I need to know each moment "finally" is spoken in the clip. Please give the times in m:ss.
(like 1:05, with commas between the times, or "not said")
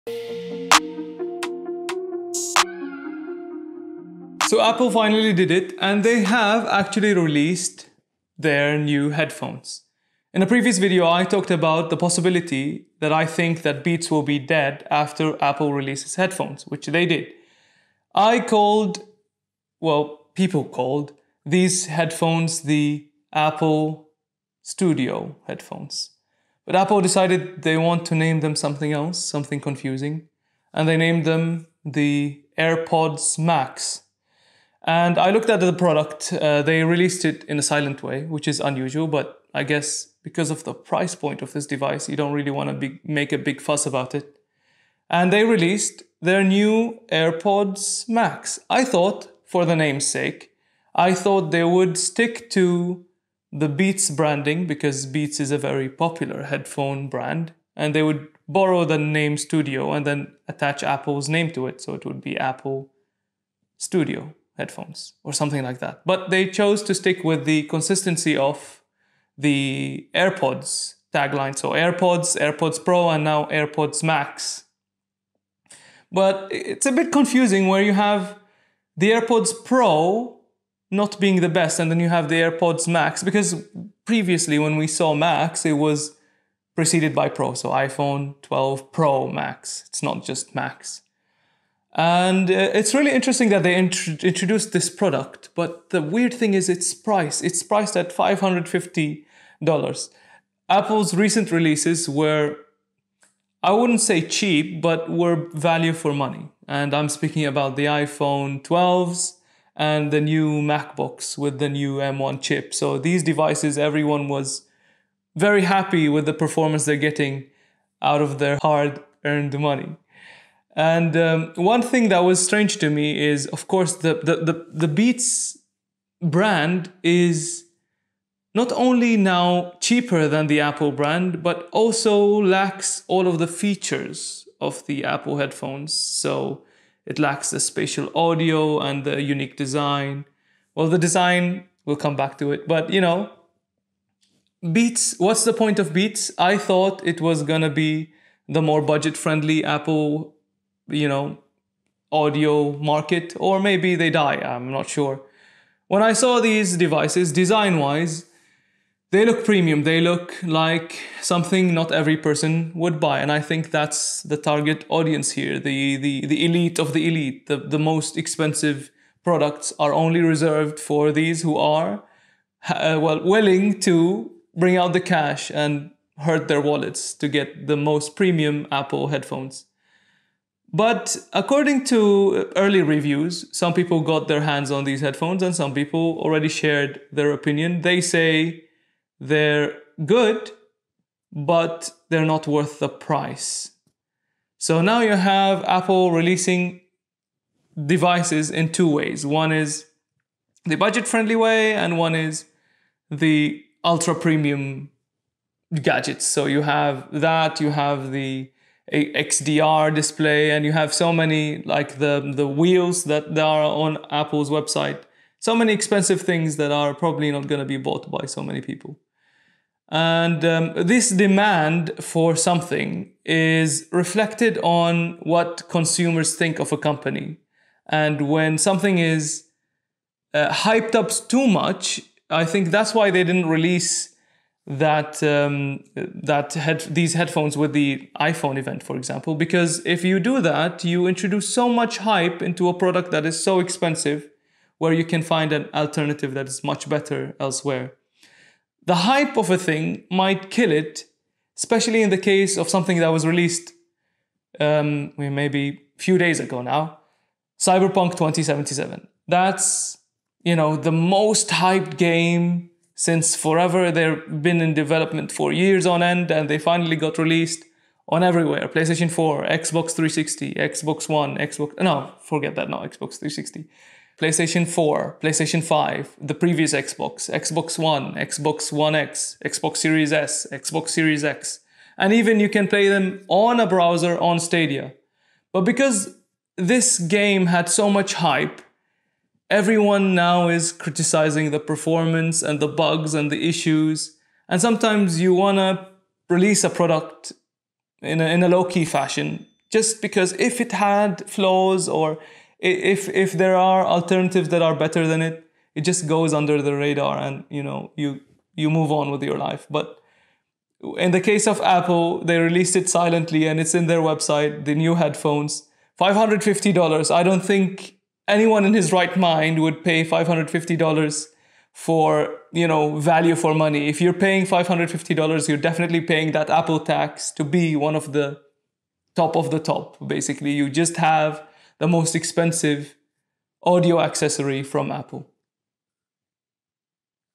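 0:04, 4:26.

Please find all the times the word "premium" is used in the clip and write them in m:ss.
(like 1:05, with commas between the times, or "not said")
2:39, 2:58, 3:24.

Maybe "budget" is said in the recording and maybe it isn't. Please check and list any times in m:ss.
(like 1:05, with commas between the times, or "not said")
2:28, 3:20.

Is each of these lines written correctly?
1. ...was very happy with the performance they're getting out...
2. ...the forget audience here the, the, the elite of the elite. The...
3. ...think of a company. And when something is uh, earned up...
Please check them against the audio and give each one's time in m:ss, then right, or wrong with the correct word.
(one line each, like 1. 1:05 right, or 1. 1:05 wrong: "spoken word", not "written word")
1. 1:54 right
2. 2:44 wrong: "target", not "forget"
3. 3:46 wrong: "hyped", not "earned".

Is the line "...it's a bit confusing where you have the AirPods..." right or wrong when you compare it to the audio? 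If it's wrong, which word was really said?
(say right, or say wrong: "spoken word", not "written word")
right.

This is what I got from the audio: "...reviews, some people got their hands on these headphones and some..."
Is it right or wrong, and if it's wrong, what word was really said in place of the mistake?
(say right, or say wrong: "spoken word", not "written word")
right.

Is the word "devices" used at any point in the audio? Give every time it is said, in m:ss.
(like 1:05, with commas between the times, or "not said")
0:41, 1:53, 2:36, 3:17.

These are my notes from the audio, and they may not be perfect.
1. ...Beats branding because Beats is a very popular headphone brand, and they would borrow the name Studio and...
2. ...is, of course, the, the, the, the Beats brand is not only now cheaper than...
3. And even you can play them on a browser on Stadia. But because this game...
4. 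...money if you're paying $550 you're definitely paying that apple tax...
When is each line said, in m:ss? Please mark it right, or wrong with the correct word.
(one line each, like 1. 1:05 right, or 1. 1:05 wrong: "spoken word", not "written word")
1. 0:53 right
2. 2:03 right
3. 4:41 right
4. 5:23 right.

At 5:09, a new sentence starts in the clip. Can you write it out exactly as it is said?
But in the case of Apple, they released it silently and it's in their website, the new headphones.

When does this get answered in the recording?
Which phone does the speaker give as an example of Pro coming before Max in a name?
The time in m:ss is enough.
1:27.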